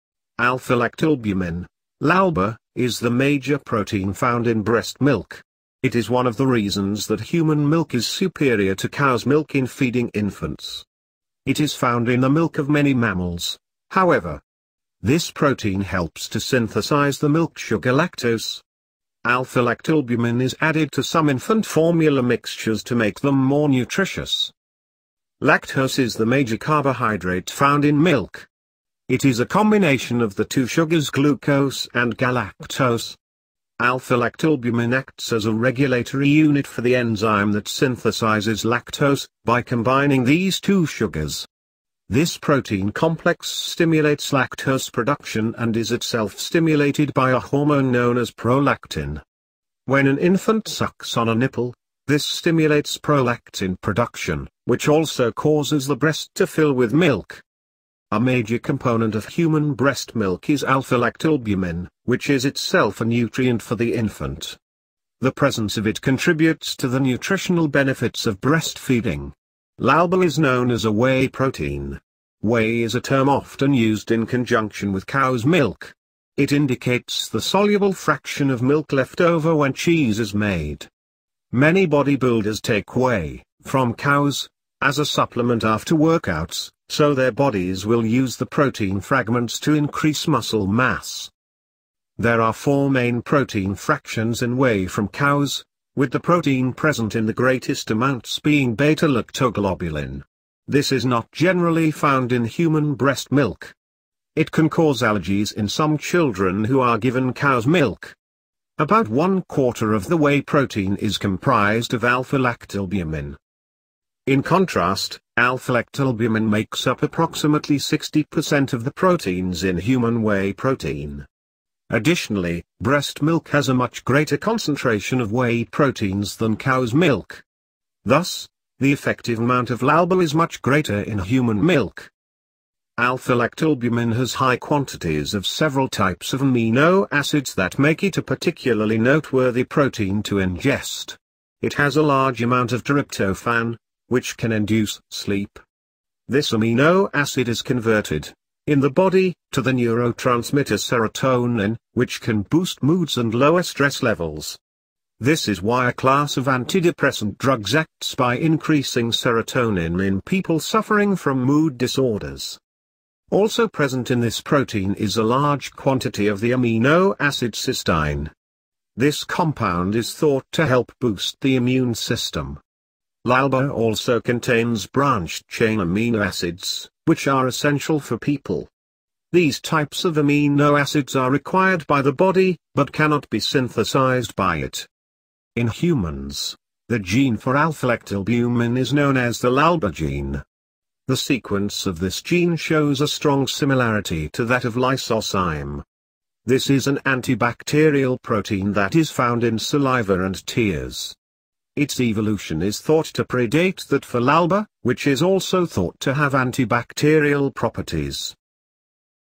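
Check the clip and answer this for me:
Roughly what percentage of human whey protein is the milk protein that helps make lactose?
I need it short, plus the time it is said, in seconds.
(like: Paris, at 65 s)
60%, at 117 s.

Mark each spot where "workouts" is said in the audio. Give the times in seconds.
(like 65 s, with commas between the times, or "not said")
85 s.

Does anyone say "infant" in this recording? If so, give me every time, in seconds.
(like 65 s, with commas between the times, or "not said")
10 s, 21 s, 50 s, 63 s.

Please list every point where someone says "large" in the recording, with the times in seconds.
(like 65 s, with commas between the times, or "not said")
142 s, 165 s.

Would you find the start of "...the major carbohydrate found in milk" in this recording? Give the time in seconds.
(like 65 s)
26 s.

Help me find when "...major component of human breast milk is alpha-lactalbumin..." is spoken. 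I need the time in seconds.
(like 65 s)
58 s.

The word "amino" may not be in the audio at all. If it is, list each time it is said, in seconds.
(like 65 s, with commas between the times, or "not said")
136 s, 146 s, 166 s, 175 s, 180 s.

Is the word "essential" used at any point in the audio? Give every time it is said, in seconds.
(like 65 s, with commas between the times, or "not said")
177 s.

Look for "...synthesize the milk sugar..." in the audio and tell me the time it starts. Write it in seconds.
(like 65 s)
16 s.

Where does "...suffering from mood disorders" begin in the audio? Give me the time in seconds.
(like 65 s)
160 s.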